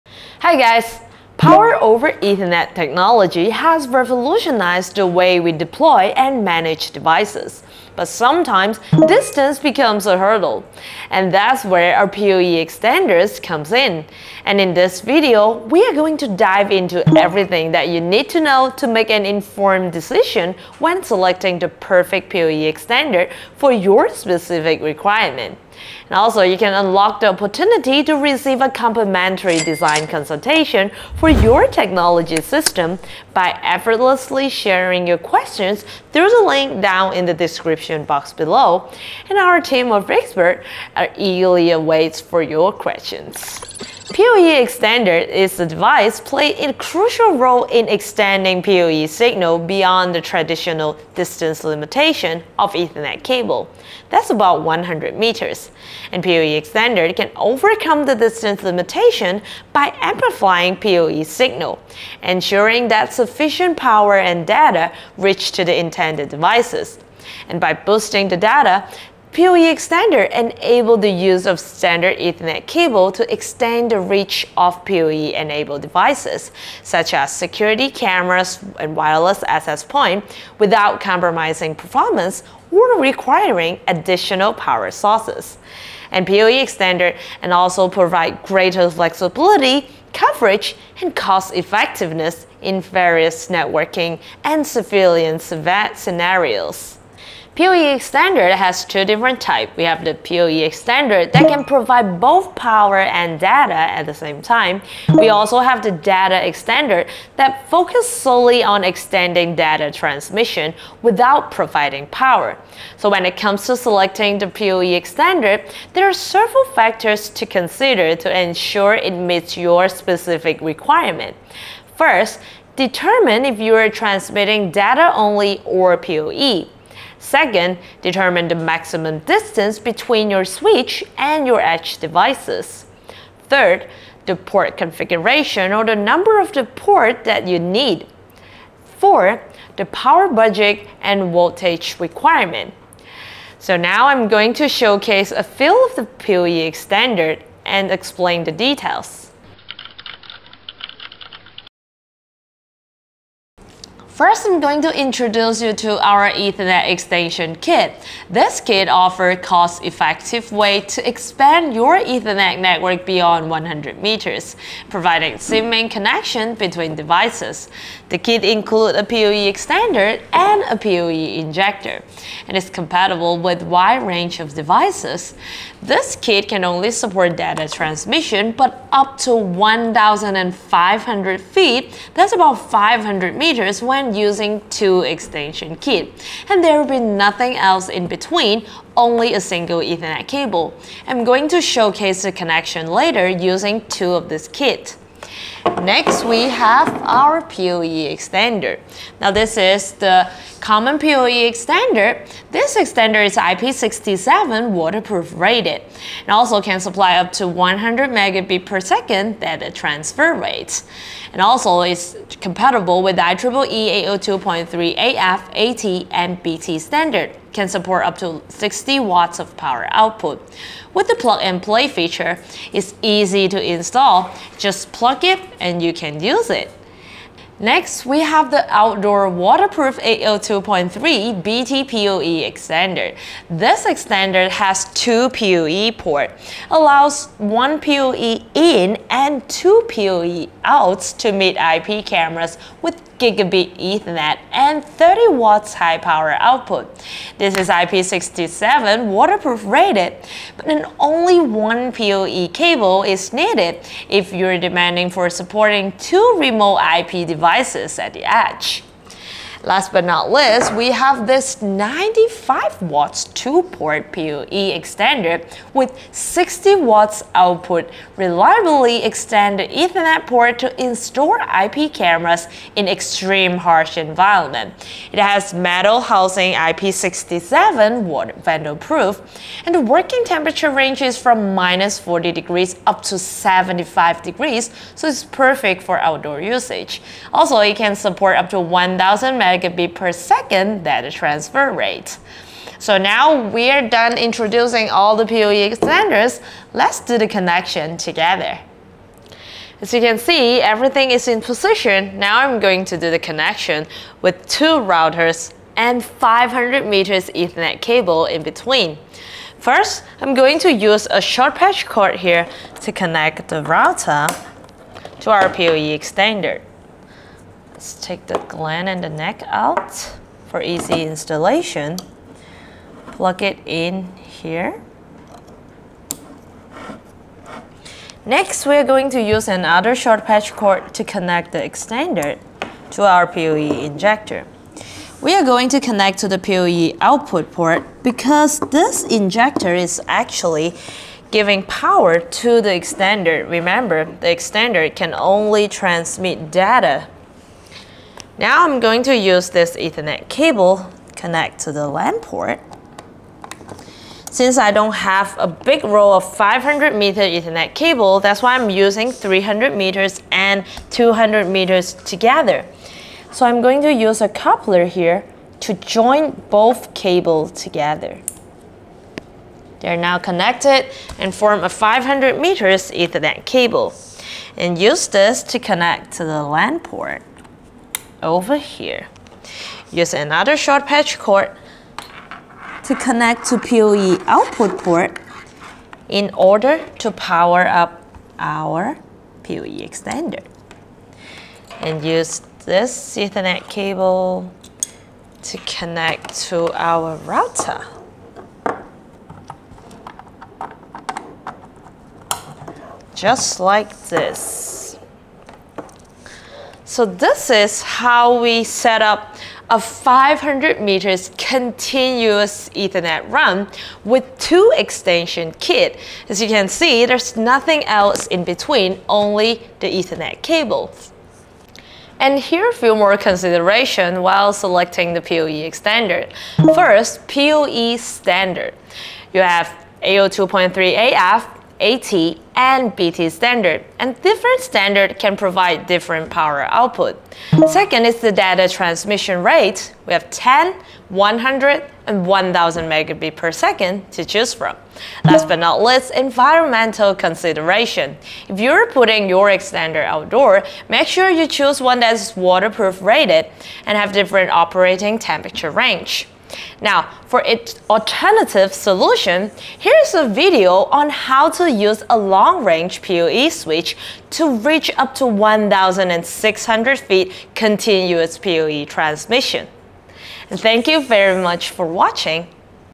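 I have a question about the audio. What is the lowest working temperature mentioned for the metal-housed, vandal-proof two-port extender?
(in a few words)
minus 40 degrees.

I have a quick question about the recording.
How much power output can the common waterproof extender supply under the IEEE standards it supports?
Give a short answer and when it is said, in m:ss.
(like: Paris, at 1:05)
60 watts, at 3:38.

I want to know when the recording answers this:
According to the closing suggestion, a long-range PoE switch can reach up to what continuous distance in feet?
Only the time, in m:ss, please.
7:45.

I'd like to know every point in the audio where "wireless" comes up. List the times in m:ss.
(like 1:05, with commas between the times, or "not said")
1:18.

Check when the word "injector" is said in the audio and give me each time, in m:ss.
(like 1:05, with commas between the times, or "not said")
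2:51, 5:33, 5:39.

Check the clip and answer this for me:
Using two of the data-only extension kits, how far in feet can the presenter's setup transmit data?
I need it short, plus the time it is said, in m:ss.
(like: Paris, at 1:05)
1,500 feet, at 2:59.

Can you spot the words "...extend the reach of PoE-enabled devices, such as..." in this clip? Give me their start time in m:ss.
1:13.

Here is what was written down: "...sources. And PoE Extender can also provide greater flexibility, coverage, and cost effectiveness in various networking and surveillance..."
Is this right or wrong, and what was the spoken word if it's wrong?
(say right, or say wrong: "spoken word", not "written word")
right.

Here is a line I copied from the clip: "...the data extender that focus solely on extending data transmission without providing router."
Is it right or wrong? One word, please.
wrong.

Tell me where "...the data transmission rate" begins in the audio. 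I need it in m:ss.
7:18.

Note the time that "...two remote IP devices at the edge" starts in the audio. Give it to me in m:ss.
4:15.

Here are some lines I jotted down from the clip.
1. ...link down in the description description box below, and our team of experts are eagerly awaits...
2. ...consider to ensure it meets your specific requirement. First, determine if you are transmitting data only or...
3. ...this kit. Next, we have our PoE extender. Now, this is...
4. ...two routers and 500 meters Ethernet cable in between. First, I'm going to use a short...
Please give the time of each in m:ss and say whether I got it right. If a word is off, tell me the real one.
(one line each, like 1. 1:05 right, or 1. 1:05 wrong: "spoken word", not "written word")
1. 0:36 right
2. 1:57 right
3. 3:14 right
4. 5:04 right.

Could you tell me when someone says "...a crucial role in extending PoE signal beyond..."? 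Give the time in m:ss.
0:46.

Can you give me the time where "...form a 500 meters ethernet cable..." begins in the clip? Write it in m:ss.
6:11.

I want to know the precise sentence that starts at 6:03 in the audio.
So I'm going to use a coupler here to join both cables together.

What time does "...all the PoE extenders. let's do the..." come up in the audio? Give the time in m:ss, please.
4:54.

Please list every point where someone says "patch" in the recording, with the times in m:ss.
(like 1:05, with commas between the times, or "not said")
5:11, 5:30, 6:20.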